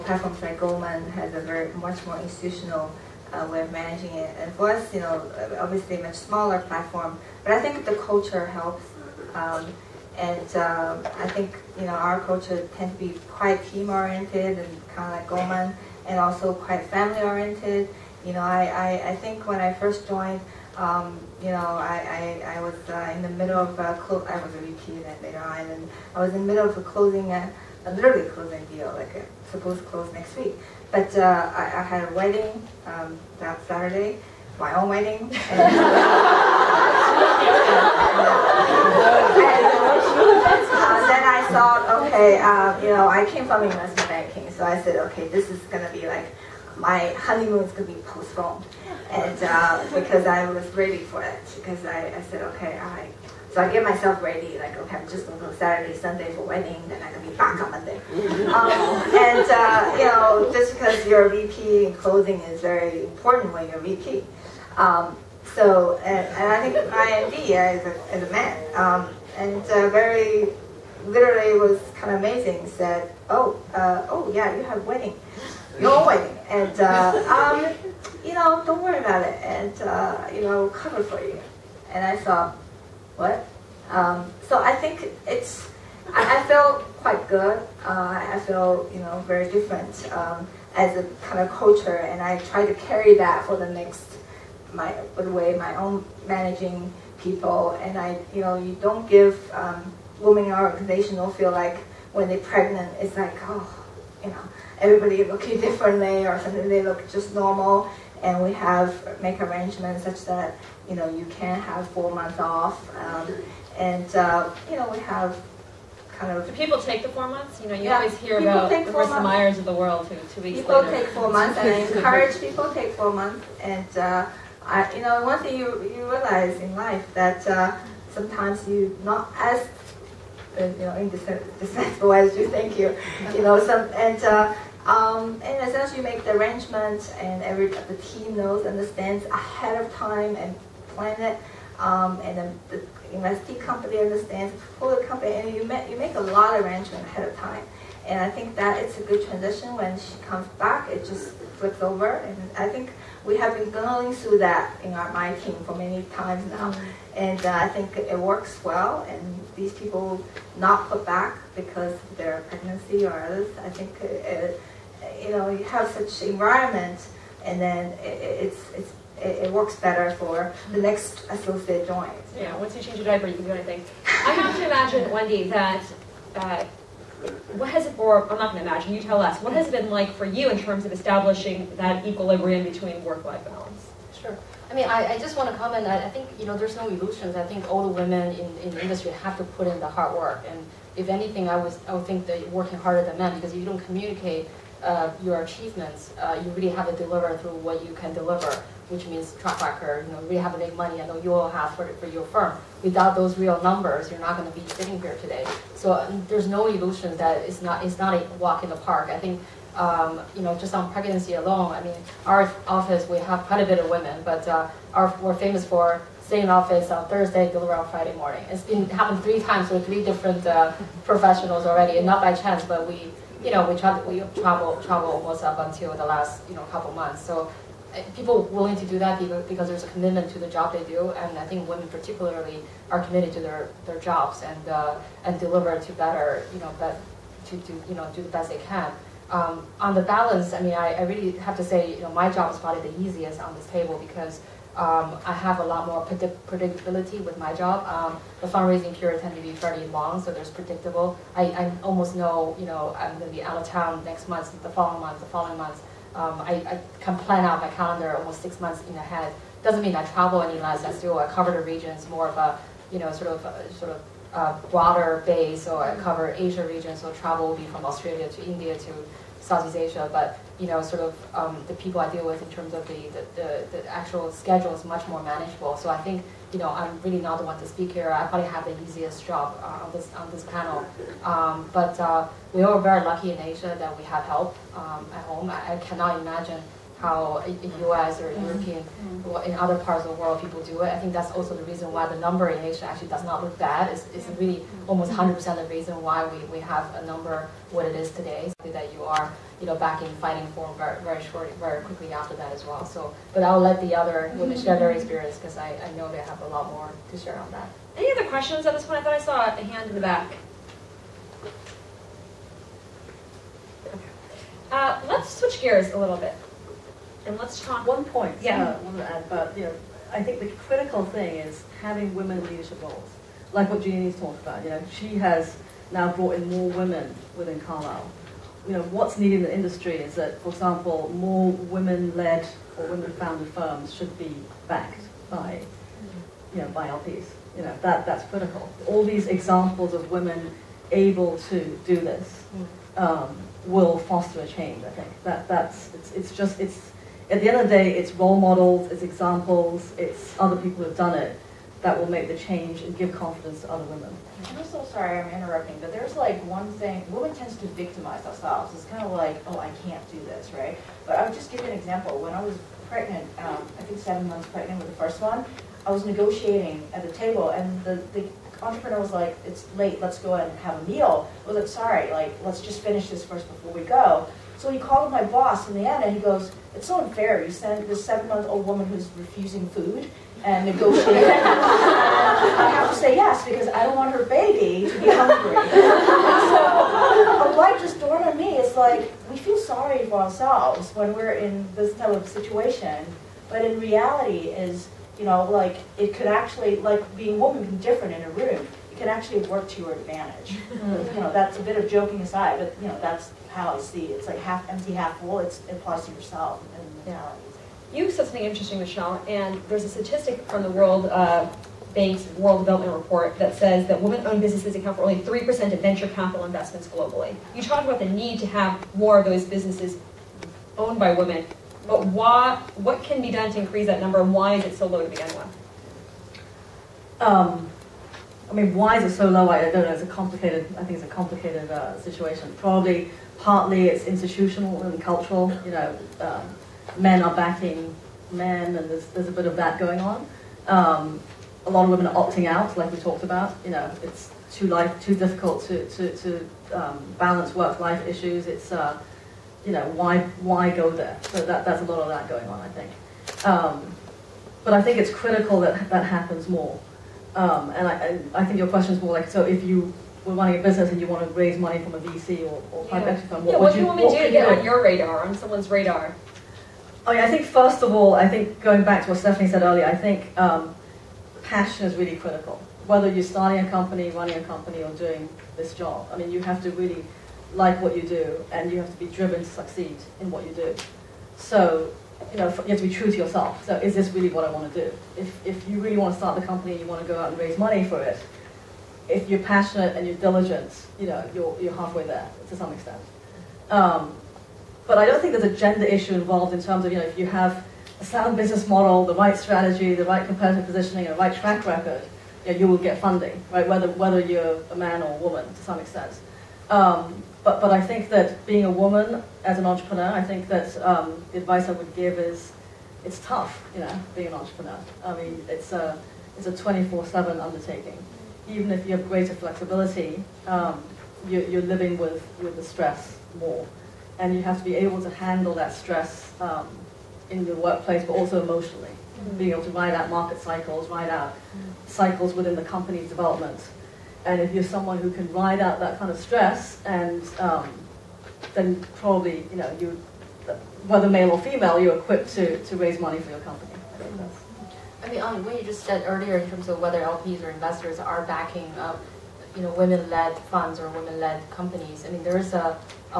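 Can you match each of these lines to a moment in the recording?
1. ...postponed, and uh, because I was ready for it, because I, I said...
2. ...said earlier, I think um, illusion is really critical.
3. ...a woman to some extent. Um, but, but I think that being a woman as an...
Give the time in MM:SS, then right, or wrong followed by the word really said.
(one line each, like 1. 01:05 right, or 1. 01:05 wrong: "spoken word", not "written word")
1. 00:48 right
2. 07:49 wrong: "passion", not "illusion"
3. 08:25 right.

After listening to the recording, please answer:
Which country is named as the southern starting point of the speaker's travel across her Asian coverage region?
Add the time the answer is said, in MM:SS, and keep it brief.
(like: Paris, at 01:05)
Australia, at 04:27.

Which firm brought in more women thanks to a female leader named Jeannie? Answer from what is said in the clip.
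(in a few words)
Carlyle.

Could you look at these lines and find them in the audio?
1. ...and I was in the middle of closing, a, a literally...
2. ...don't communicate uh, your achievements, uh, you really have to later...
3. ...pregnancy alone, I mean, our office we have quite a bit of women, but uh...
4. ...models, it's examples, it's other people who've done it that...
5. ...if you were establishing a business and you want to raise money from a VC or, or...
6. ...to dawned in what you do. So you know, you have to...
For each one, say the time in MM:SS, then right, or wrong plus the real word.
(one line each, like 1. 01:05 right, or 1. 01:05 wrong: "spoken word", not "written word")
1. 00:25 right
2. 03:13 wrong: "deliver", not "later"
3. 03:30 right
4. 05:48 right
5. 07:39 wrong: "running", not "establishing"
6. 07:59 wrong: "succeed", not "dawned".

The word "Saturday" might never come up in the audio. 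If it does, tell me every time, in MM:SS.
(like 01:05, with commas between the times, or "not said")
00:33, 00:55.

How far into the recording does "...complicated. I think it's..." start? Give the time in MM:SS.
07:10.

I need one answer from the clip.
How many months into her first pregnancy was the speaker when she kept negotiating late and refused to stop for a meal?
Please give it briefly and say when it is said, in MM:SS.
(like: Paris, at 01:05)
7, at 06:03.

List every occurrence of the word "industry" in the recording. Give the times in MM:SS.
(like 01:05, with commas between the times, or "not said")
03:08, 05:29.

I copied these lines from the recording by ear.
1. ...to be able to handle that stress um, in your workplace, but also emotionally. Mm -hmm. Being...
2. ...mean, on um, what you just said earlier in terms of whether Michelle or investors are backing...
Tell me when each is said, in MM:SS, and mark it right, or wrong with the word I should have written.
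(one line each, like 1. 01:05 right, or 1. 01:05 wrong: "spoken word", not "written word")
1. 08:44 right
2. 09:05 wrong: "LPs", not "Michelle".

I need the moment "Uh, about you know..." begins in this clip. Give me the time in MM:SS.
05:18.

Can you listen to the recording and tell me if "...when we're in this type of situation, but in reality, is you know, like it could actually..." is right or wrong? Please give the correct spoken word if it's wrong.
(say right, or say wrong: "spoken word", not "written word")
right.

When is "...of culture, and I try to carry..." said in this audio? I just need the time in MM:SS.
01:31.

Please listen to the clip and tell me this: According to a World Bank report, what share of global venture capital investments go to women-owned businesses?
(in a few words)
3%.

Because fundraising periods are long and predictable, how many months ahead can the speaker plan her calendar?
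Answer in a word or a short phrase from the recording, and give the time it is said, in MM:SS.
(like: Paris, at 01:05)
6 months, at 04:18.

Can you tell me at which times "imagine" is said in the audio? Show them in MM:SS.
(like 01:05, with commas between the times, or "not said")
02:54, 02:58, 04:46.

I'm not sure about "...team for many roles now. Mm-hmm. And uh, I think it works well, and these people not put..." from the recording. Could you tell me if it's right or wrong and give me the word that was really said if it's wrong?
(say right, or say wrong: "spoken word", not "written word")
wrong: "times", not "roles".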